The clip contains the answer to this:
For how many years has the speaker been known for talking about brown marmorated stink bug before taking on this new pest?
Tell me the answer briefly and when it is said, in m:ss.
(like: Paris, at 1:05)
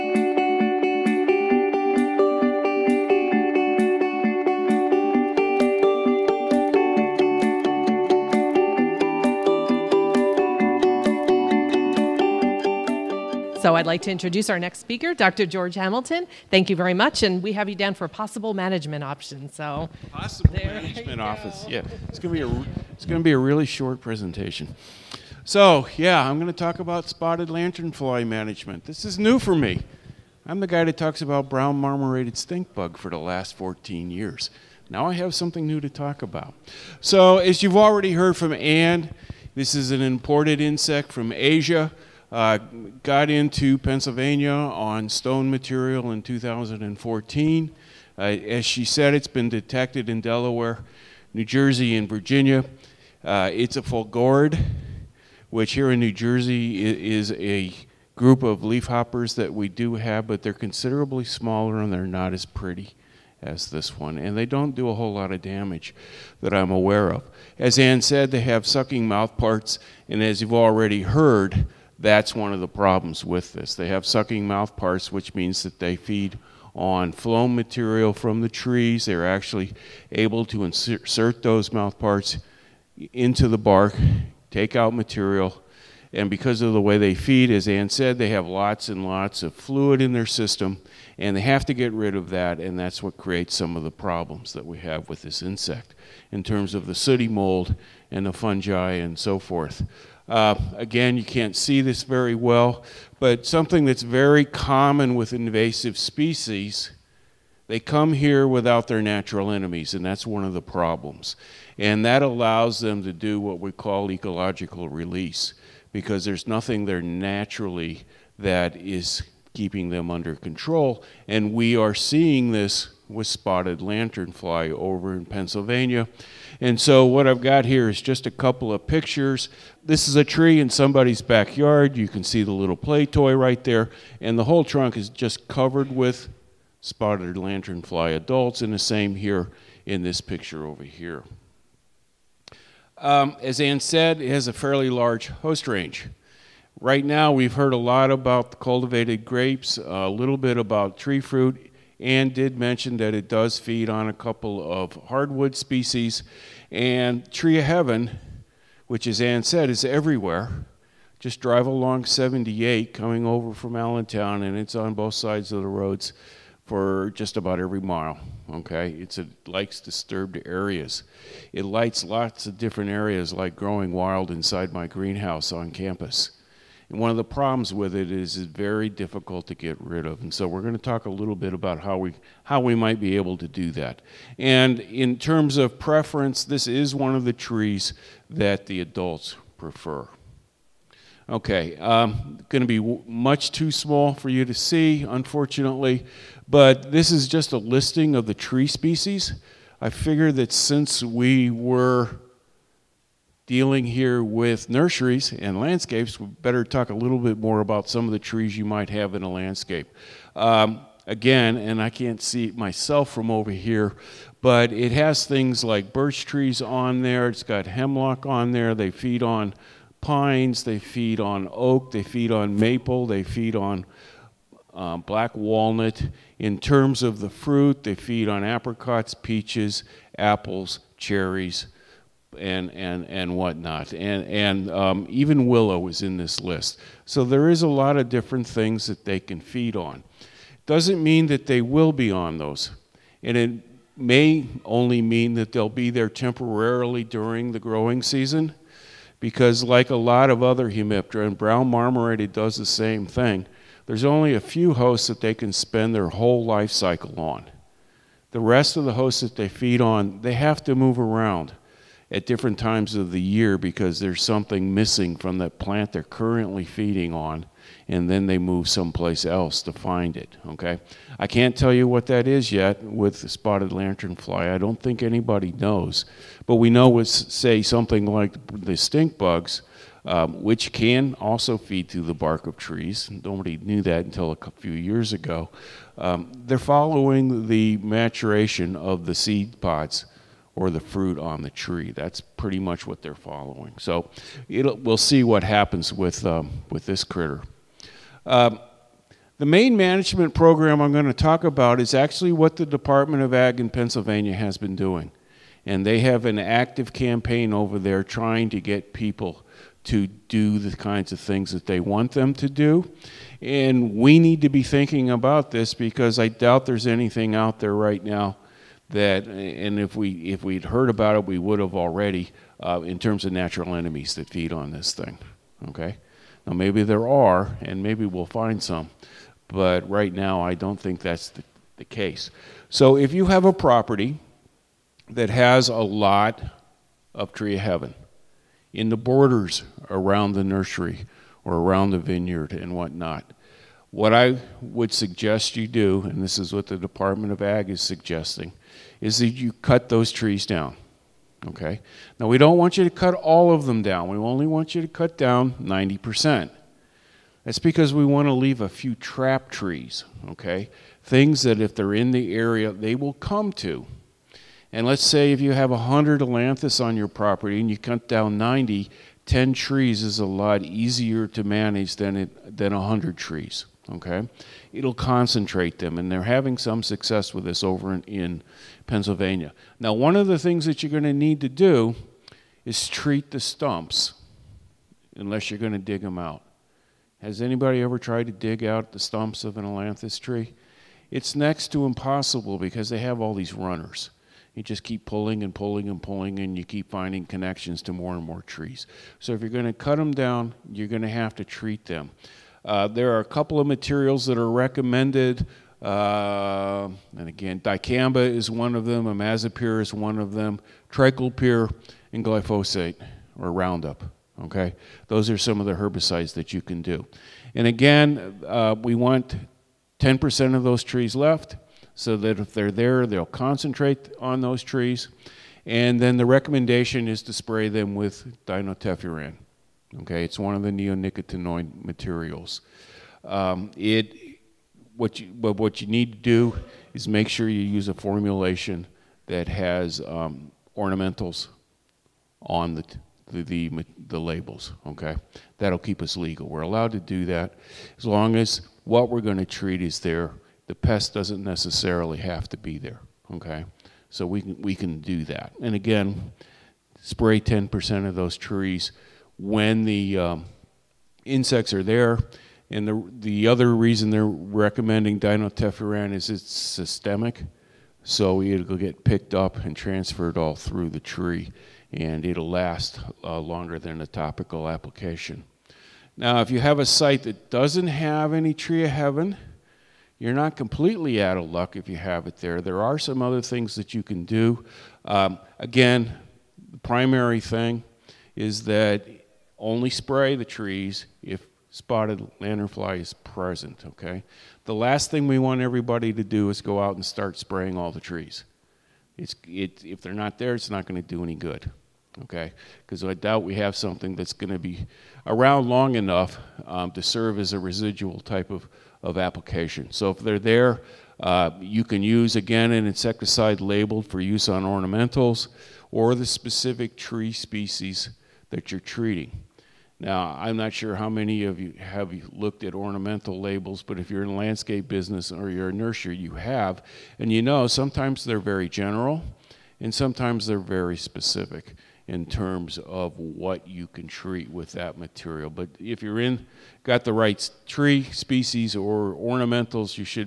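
14 years, at 0:33.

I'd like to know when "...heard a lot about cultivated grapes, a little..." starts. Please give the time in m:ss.
2:27.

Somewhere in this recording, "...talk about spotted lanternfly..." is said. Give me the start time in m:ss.
0:26.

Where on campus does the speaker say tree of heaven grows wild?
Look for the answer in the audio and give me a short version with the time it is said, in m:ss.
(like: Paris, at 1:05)
Greenhouse, at 2:54.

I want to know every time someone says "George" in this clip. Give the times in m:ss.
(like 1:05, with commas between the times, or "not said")
0:15.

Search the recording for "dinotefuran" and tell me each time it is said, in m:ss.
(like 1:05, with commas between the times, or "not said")
7:08, 7:45.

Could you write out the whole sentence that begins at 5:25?
Okay, now maybe there are, and maybe we'll find some, but right now I don't think that's the, the case.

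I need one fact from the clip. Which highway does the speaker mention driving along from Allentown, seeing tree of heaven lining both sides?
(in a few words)
78.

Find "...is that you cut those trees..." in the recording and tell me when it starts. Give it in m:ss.
5:49.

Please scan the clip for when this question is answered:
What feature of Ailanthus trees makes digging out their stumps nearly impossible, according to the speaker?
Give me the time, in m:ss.
6:33.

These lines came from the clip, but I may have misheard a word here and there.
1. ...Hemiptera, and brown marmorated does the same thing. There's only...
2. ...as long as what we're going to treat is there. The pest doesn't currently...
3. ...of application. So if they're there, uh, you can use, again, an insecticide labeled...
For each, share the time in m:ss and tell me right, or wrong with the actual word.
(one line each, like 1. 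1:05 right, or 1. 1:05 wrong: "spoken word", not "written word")
1. 4:10 right
2. 7:27 wrong: "necessarily", not "currently"
3. 8:29 right.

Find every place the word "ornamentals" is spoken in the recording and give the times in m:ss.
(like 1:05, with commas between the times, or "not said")
7:20, 8:34, 8:42, 8:59.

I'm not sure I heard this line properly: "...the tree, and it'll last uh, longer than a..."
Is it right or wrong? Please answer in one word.
right.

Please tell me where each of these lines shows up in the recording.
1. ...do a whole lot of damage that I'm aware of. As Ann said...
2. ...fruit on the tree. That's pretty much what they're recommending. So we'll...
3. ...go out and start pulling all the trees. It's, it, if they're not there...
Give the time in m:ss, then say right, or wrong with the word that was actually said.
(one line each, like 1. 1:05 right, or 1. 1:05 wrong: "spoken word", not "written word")
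1. 1:04 right
2. 4:50 wrong: "following", not "recommending"
3. 8:16 wrong: "spraying", not "pulling".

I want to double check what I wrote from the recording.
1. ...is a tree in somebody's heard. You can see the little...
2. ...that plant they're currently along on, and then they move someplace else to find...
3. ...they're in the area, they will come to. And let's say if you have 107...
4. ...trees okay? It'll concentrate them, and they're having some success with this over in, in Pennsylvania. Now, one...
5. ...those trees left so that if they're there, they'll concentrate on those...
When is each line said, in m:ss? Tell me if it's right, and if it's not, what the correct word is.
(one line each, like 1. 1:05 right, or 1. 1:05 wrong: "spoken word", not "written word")
1. 2:10 wrong: "backyard", not "heard"
2. 4:25 wrong: "feeding", not "along"
3. 6:01 wrong: "100", not "107"
4. 6:13 right
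5. 7:00 right.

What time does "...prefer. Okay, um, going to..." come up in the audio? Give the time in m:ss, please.
3:09.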